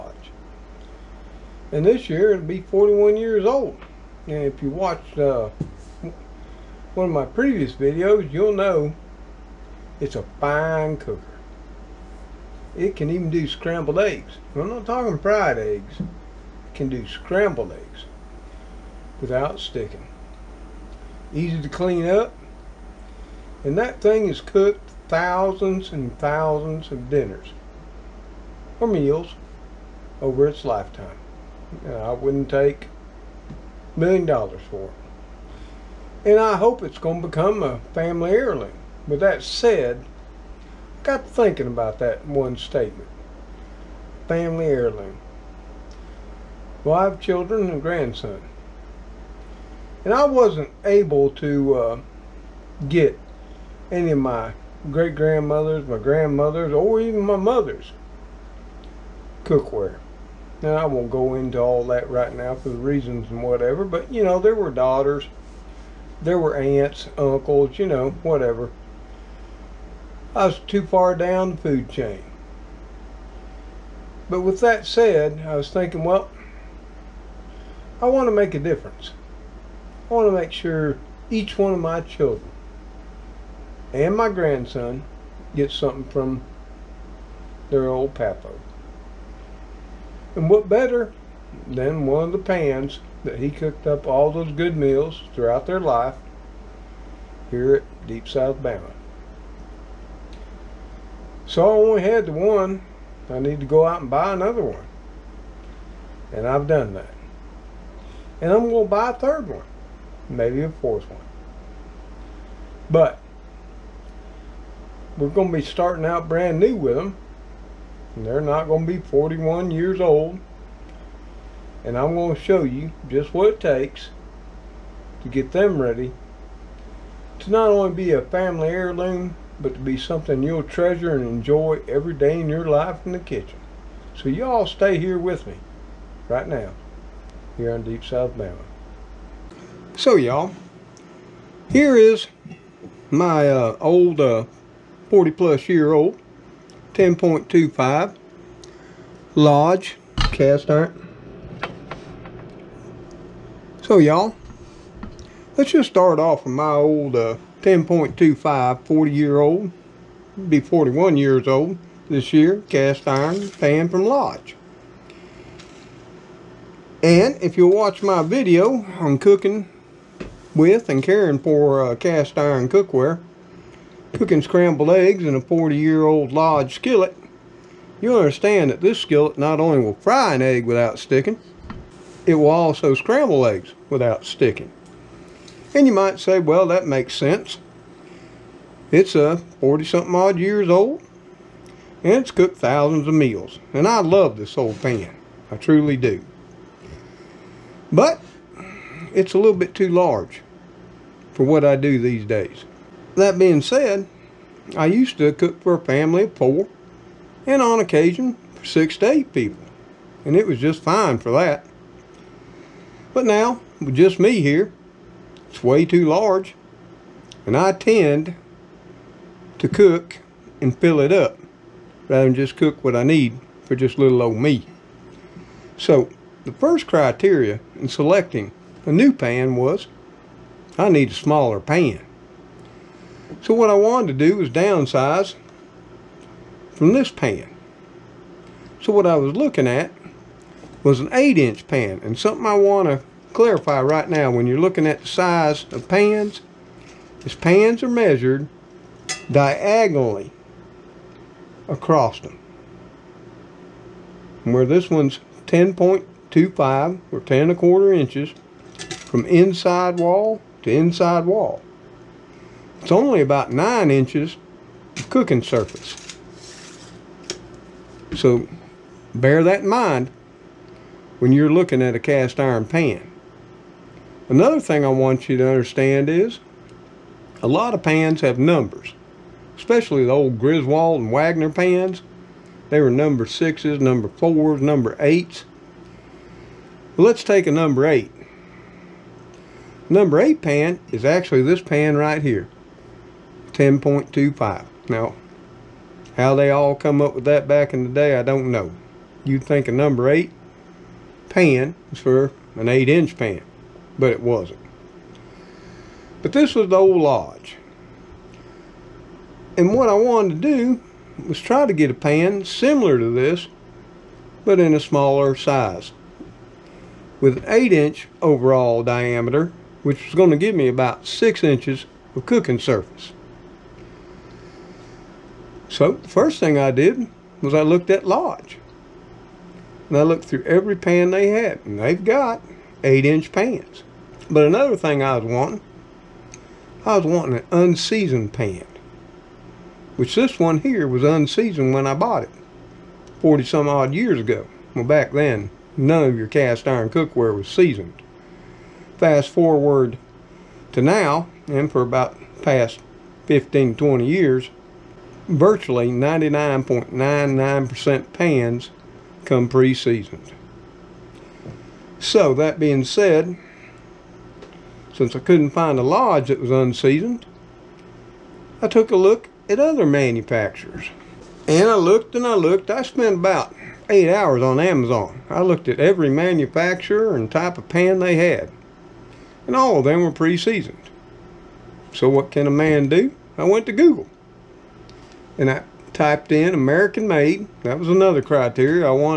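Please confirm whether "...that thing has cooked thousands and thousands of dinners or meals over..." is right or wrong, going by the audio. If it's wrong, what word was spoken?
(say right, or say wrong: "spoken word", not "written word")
right.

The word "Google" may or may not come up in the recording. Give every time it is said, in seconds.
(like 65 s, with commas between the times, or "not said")
383 s.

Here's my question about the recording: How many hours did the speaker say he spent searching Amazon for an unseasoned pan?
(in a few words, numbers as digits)
8 hours.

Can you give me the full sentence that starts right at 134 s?
So y'all stay here with me right now here on Deep South Bama.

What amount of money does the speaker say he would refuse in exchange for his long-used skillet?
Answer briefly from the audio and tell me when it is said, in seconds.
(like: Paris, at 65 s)
a million dollars, at 33 s.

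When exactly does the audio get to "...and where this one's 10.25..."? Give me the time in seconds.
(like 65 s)
254 s.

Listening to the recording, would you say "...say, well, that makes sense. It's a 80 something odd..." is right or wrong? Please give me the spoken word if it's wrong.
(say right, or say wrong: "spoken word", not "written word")
wrong: "40", not "80".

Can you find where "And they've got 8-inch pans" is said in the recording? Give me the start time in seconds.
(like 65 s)
331 s.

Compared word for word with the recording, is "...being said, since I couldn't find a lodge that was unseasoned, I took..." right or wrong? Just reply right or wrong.
right.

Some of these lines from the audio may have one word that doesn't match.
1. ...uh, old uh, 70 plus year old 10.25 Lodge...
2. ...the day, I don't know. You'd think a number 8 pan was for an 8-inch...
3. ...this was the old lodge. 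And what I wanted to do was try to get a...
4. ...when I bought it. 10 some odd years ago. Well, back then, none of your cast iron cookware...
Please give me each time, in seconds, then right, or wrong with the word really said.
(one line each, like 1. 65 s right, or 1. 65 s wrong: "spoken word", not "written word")
1. 143 s wrong: "40", not "70"
2. 297 s right
3. 306 s right
4. 341 s wrong: "40", not "10".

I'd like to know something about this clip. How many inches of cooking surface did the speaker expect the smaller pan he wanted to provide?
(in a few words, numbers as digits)
6 inches.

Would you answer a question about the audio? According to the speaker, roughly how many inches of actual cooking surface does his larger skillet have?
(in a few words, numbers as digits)
9 inches.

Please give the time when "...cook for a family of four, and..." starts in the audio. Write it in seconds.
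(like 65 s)
205 s.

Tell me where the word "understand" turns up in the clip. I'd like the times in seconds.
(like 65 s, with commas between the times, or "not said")
178 s, 275 s.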